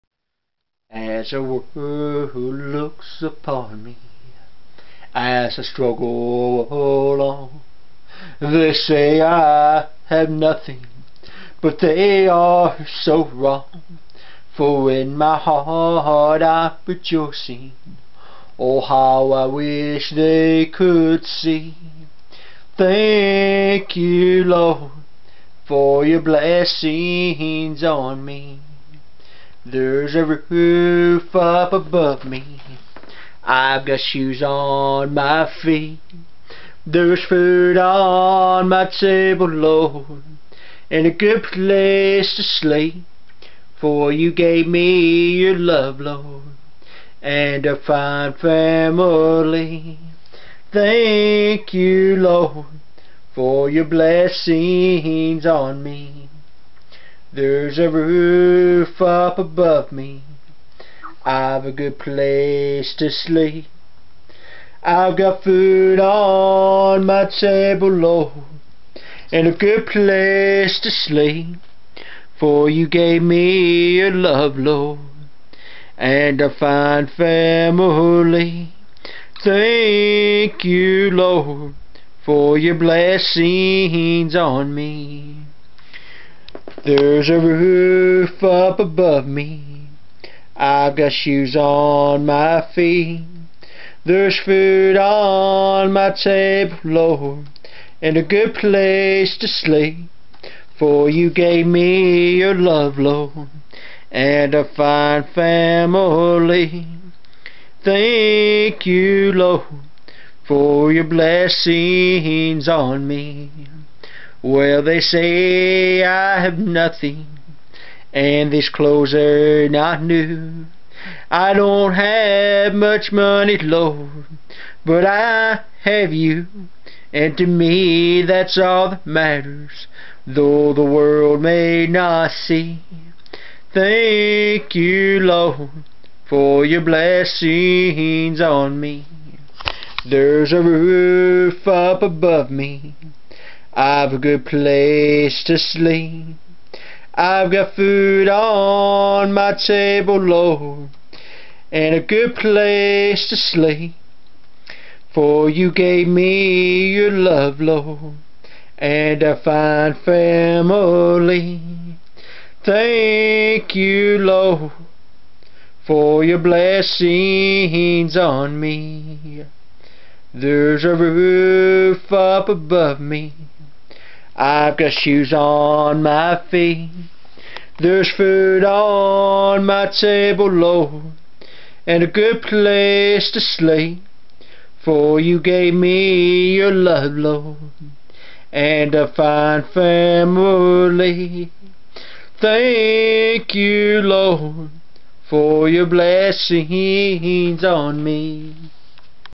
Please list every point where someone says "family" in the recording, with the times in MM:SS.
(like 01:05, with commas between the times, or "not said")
00:48, 01:17, 01:45, 02:40, 03:09.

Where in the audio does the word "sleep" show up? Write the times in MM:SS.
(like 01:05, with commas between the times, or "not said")
00:42, 01:03, 01:10, 01:39, 02:25, 02:33, 03:03.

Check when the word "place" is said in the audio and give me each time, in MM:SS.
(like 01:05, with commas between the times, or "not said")
00:41, 01:01, 01:09, 01:38, 02:24, 02:32, 03:02.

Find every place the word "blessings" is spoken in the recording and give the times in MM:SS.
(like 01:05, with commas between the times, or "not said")
00:26, 00:53, 01:22, 01:51, 02:16, 02:46, 03:15.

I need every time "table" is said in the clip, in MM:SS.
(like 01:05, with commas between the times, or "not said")
00:38, 01:07, 01:36, 02:29, 02:59.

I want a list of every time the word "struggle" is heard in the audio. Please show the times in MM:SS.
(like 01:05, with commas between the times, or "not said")
00:05.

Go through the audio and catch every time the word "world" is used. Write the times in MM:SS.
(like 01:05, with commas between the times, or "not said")
00:01, 02:10.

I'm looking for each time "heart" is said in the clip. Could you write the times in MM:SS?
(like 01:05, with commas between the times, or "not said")
00:15.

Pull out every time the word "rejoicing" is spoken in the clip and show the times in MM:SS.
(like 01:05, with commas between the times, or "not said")
00:16.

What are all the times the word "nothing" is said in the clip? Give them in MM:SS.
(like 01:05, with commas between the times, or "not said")
00:10, 01:56.